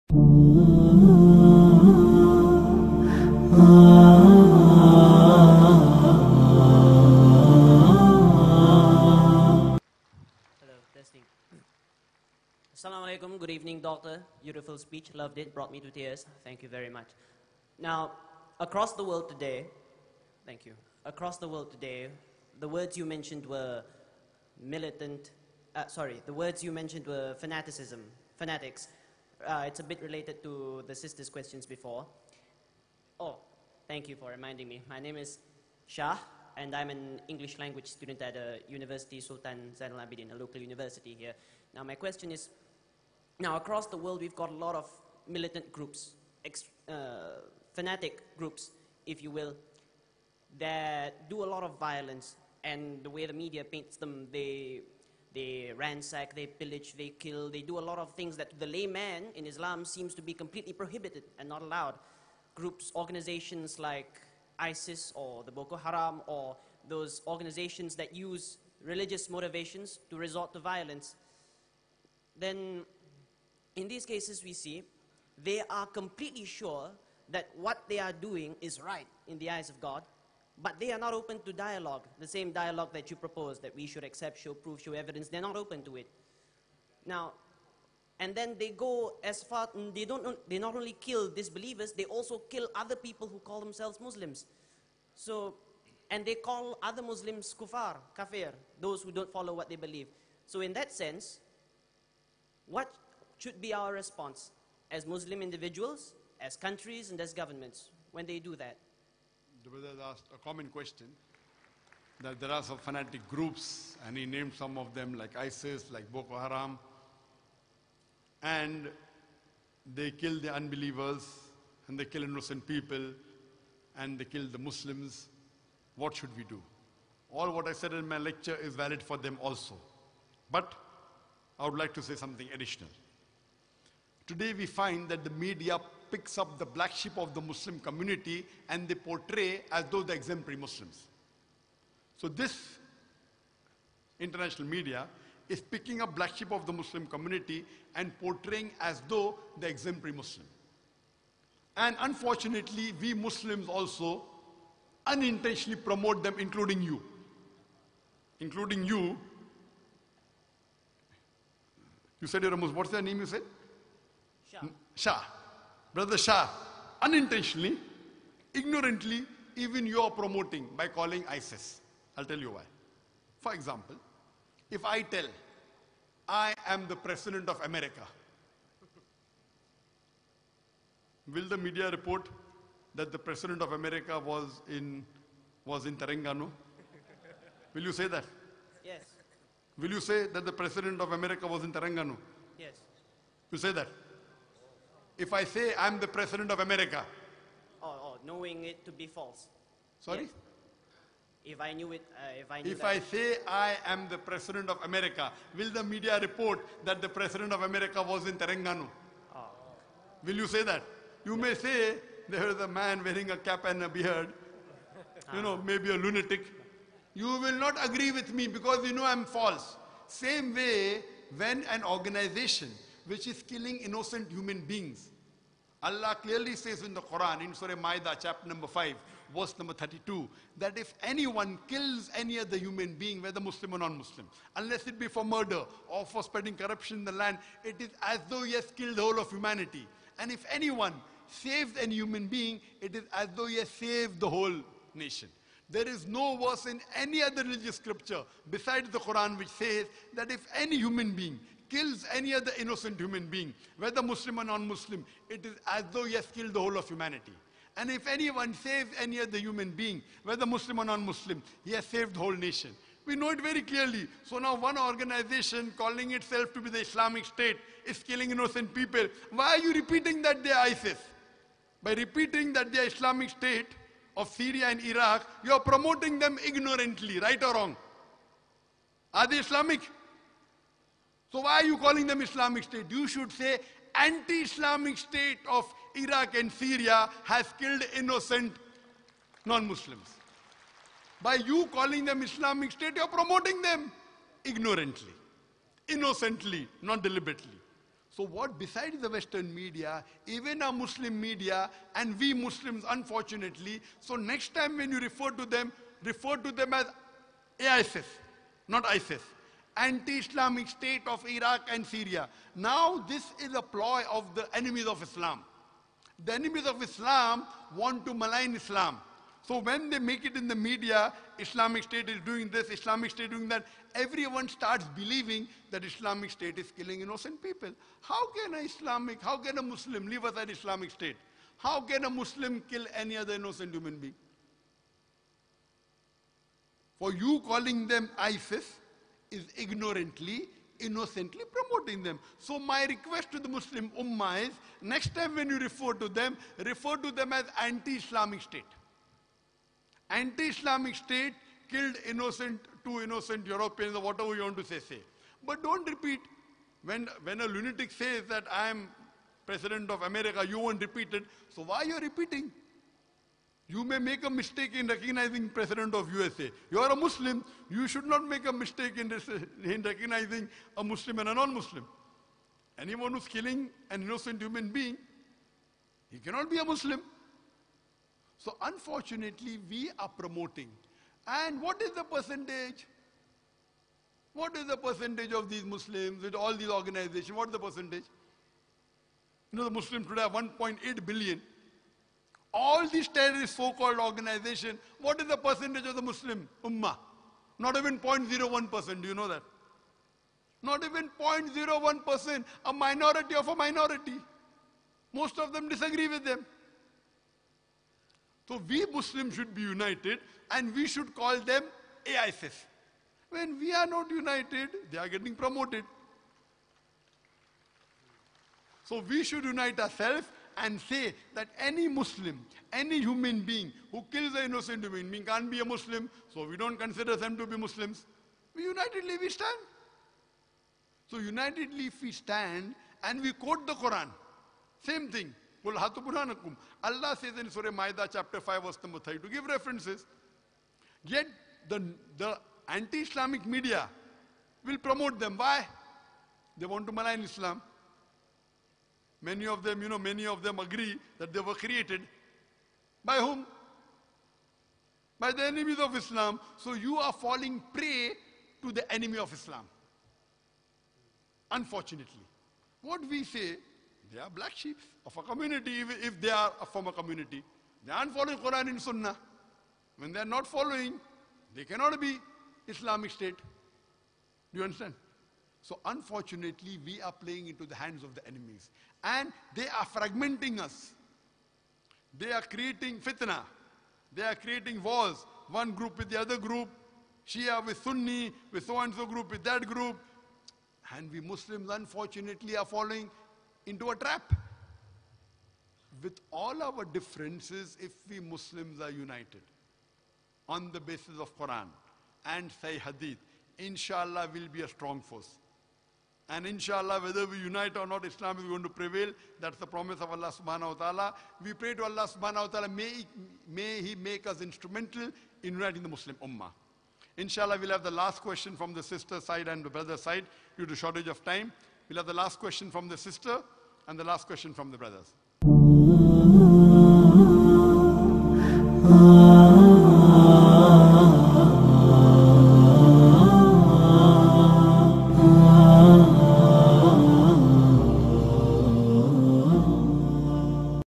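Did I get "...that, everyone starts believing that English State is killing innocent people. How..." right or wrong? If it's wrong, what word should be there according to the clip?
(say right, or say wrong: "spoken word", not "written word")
wrong: "Islamic", not "English".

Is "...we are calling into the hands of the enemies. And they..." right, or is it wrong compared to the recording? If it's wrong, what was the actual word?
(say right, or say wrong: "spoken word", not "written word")
wrong: "playing", not "calling".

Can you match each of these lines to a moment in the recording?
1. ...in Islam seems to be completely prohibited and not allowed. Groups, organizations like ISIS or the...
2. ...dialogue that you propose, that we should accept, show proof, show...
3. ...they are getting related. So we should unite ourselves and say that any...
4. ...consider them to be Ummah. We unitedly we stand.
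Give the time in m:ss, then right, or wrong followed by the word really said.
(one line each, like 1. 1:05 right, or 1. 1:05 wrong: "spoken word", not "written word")
1. 0:59 right
2. 1:22 right
3. 6:54 wrong: "promoted", not "related"
4. 7:06 wrong: "Muslims", not "Ummah".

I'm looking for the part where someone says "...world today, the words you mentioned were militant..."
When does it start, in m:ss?
0:21.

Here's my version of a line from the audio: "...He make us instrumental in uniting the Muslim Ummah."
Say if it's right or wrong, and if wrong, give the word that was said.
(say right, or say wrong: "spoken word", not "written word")
right.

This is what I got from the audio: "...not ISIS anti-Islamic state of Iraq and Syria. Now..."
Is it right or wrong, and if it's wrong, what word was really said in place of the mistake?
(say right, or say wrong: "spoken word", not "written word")
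right.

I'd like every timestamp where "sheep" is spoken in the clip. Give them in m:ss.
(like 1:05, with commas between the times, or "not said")
2:16, 2:26, 7:44.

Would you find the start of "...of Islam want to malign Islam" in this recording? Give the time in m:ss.
5:16.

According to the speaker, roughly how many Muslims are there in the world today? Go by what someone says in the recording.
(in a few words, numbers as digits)
1.8 billion.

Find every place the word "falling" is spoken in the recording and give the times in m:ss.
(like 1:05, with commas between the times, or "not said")
7:37, 8:12.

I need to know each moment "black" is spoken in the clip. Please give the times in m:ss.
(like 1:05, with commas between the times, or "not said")
2:16, 2:26, 7:44.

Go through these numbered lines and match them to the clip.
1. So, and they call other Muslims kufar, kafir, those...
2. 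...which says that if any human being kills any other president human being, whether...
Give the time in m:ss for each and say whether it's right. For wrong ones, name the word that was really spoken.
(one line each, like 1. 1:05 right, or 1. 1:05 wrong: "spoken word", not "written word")
1. 1:35 right
2. 4:09 wrong: "innocent", not "president".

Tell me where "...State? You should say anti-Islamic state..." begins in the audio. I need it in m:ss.
4:42.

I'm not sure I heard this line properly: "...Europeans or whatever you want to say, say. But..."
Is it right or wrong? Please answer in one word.
right.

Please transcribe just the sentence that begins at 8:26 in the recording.
And inshallah, whether we unite or not, Islam is going to prevail.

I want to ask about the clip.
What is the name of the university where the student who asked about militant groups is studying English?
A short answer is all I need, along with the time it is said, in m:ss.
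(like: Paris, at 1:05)
University Sultan Zainal Abidin, at 0:38.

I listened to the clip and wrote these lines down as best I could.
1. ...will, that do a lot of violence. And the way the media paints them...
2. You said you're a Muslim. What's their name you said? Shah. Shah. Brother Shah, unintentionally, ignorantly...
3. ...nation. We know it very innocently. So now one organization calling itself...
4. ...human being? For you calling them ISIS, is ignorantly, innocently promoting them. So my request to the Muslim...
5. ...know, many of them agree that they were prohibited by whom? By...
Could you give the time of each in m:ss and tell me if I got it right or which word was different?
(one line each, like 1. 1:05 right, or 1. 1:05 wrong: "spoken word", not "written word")
1. 0:49 right
2. 2:42 right
3. 4:22 wrong: "clearly", not "innocently"
4. 5:33 right
5. 7:29 wrong: "created", not "prohibited".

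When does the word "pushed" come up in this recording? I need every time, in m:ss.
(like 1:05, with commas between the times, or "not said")
not said.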